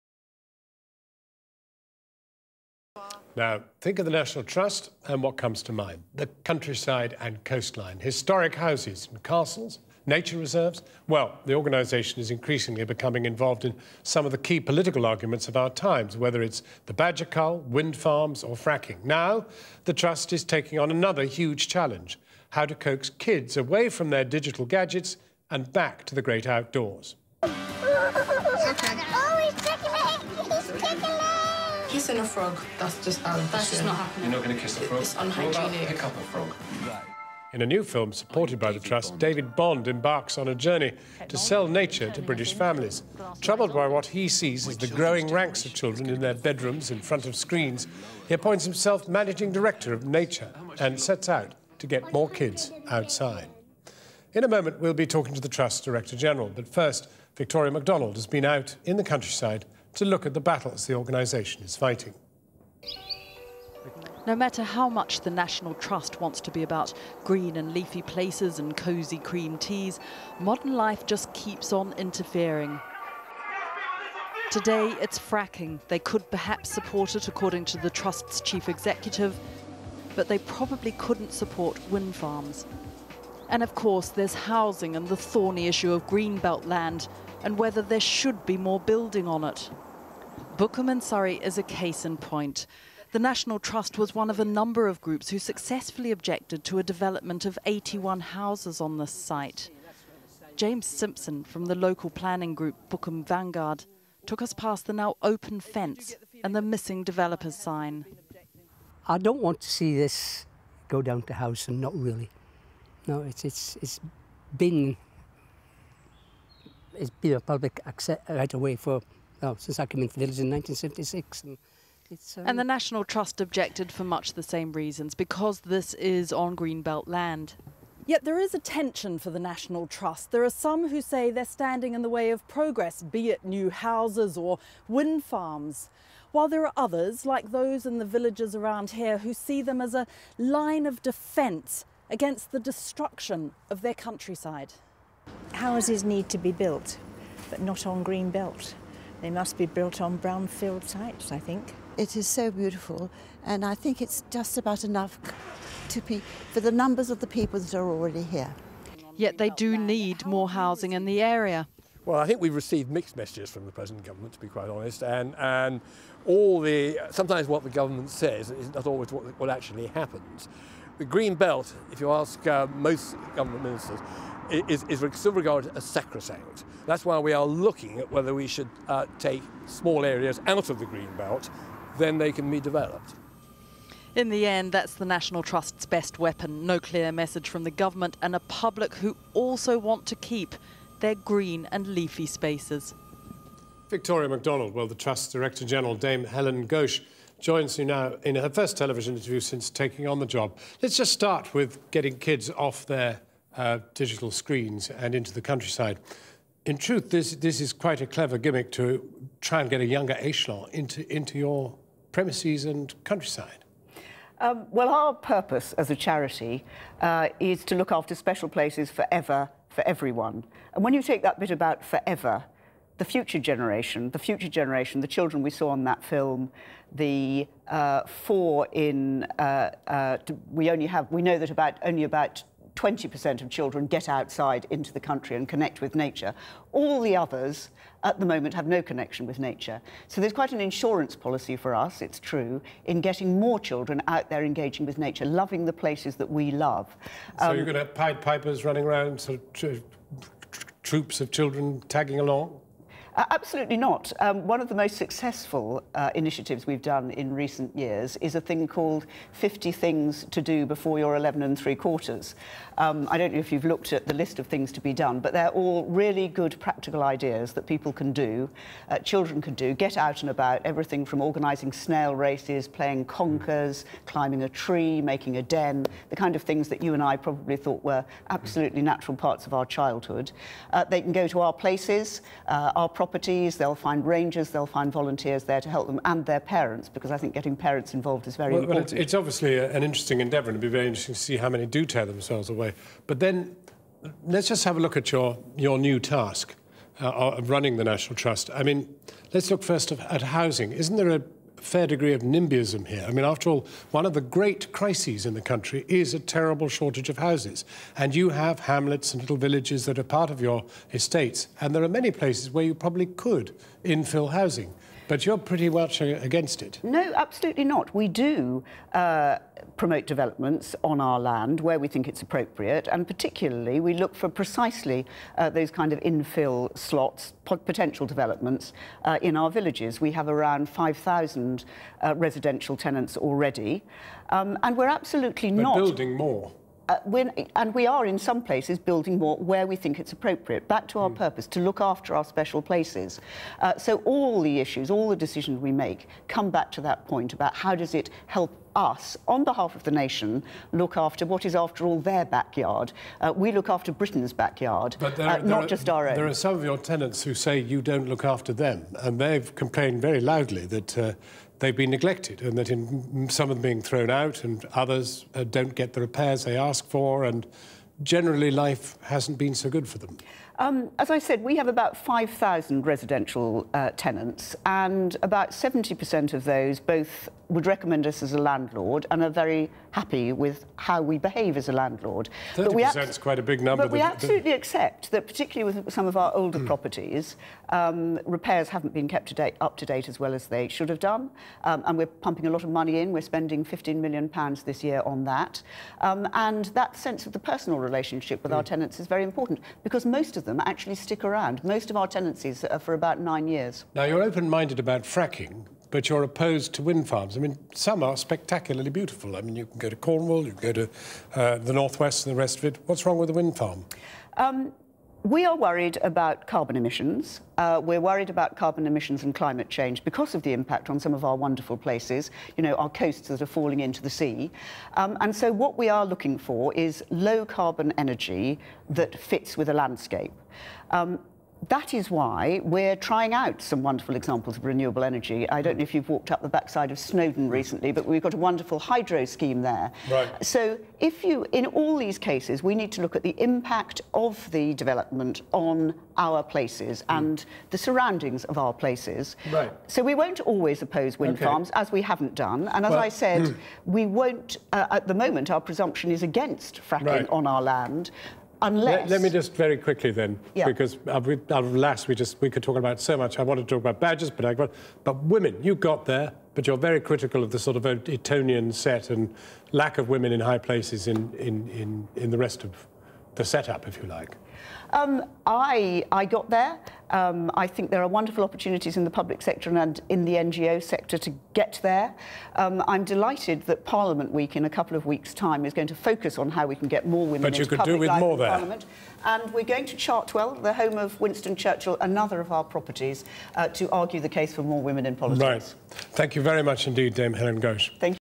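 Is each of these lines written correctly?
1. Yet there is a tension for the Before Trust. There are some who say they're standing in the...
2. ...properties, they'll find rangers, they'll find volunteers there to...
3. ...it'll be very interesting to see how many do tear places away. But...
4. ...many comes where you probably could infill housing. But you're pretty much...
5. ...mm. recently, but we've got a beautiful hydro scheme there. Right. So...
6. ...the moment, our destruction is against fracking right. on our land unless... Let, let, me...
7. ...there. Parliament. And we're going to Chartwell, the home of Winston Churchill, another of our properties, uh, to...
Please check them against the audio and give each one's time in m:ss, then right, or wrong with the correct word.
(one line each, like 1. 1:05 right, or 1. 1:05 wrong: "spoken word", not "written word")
1. 2:08 wrong: "National", not "Before"
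2. 4:43 right
3. 4:50 wrong: "themselves", not "places"
4. 5:11 wrong: "places", not "comes"
5. 7:17 wrong: "wonderful", not "beautiful"
6. 7:35 wrong: "presumption", not "destruction"
7. 8:08 right.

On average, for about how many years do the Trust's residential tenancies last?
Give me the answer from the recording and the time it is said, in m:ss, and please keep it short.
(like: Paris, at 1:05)
9 years, at 6:43.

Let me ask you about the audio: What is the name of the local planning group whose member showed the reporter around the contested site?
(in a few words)
Bookham Vanguard.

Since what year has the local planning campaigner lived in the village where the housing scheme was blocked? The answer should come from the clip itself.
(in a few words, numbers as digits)
1976.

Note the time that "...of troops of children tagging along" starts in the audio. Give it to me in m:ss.
4:09.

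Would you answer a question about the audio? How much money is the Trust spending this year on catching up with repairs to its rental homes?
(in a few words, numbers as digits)
£15 million.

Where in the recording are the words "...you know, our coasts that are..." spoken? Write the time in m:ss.
7:02.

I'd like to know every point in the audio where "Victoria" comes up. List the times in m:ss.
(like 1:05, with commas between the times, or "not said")
0:57, 3:13.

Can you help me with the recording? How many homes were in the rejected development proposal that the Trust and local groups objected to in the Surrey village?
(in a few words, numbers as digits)
81.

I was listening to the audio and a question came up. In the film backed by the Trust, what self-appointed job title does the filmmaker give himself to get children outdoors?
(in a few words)
Managing director of nature.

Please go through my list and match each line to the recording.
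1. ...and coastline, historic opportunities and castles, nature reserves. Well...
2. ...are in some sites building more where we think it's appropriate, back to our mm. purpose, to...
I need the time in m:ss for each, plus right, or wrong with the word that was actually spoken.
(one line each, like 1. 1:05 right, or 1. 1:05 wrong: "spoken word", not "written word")
1. 0:07 wrong: "houses", not "opportunities"
2. 5:37 wrong: "places", not "sites".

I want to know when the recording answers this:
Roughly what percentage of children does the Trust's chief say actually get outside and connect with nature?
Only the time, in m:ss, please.
3:52.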